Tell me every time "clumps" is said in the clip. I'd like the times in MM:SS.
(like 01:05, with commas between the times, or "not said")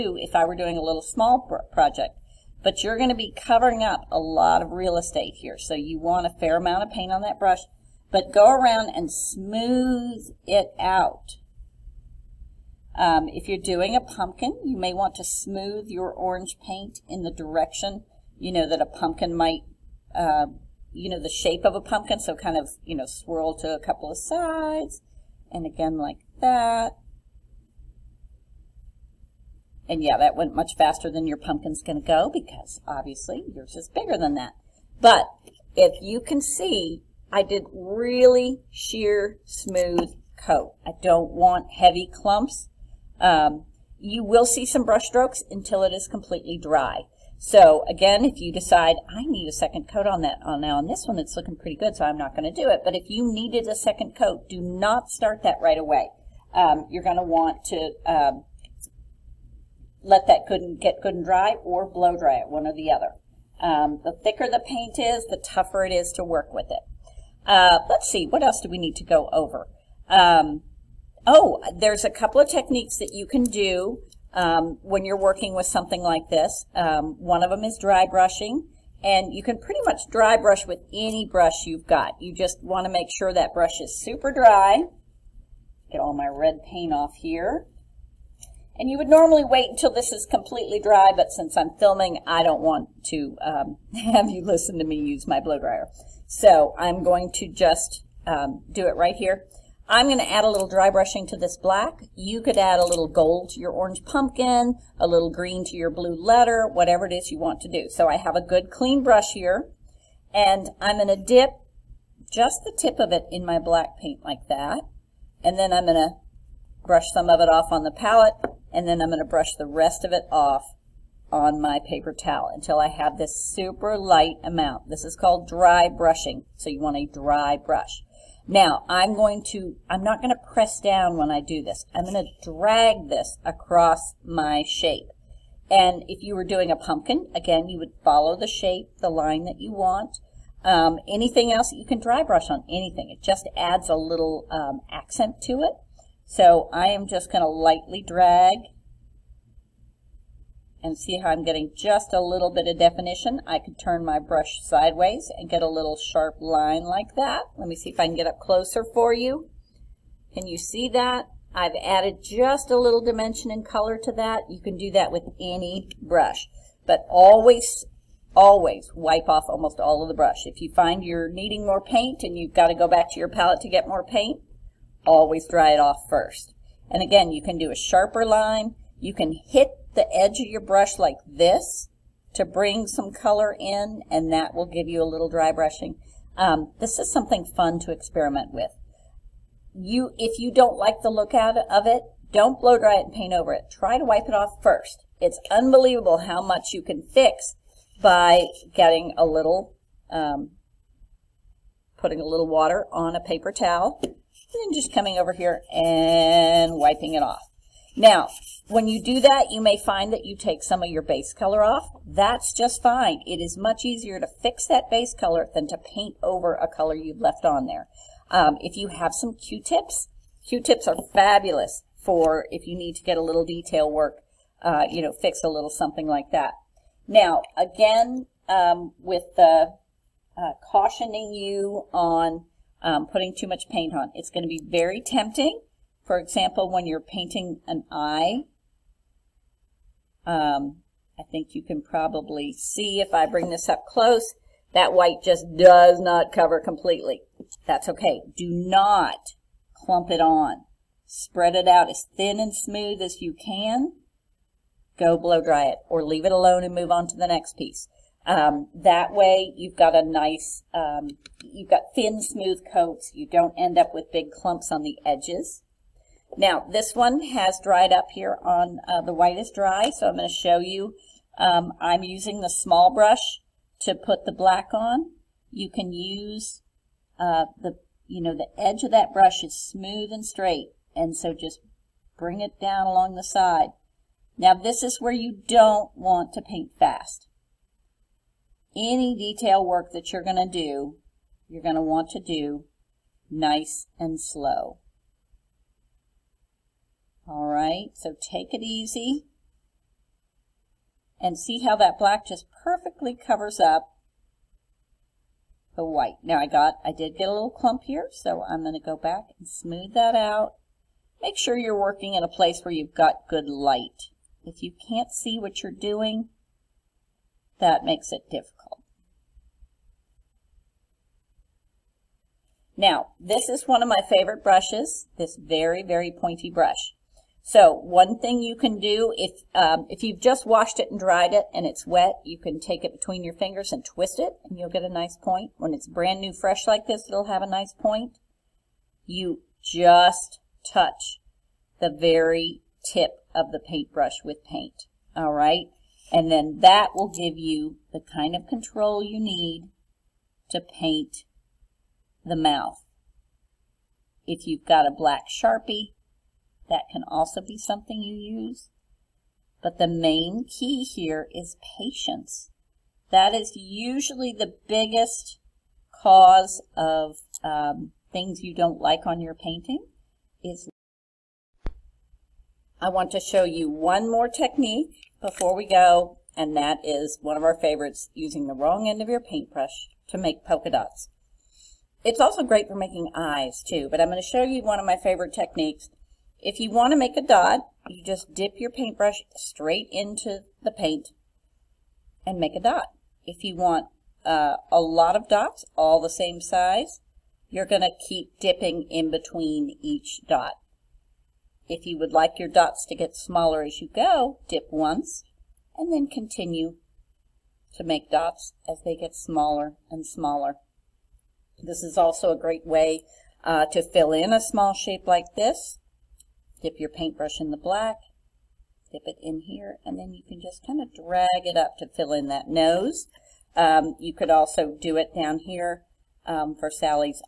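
00:42, 04:09, 04:24, 05:07.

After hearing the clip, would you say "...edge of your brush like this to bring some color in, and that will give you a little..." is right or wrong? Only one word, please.
right.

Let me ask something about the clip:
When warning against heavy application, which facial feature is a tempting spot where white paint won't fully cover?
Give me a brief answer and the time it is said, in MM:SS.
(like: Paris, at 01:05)
an eye, at 03:57.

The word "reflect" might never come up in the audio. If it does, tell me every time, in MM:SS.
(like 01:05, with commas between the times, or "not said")
not said.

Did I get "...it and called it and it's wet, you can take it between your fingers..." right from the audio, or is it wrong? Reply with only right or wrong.
wrong.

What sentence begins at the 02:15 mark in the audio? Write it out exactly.
And if you were doing a pumpkin, again, you would follow the shape, the line that you want.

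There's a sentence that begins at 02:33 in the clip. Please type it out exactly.
I could turn my brush sideways and get a little sharp line like that.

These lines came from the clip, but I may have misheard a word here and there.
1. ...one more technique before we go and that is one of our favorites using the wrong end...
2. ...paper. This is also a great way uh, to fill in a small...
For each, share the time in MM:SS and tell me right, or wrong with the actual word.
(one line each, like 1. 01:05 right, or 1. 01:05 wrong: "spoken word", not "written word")
1. 06:13 right
2. 06:50 wrong: "smaller", not "paper".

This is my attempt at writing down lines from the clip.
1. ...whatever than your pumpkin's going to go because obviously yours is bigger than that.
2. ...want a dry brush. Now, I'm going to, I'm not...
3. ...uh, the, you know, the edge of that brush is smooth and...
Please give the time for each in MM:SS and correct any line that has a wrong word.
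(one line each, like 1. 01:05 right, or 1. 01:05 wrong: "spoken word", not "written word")
1. 00:30 wrong: "faster", not "whatever"
2. 02:06 right
3. 04:37 right.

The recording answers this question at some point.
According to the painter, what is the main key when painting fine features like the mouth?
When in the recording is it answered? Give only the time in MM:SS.
06:01.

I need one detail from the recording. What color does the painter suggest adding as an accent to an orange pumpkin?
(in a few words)
gold.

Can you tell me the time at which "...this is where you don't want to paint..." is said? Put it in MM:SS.
04:44.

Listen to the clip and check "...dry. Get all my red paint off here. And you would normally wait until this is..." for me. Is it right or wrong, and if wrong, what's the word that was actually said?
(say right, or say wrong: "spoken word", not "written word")
right.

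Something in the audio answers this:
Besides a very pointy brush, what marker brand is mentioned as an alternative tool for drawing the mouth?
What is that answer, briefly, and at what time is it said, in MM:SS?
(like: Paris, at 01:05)
Sharpie, at 05:55.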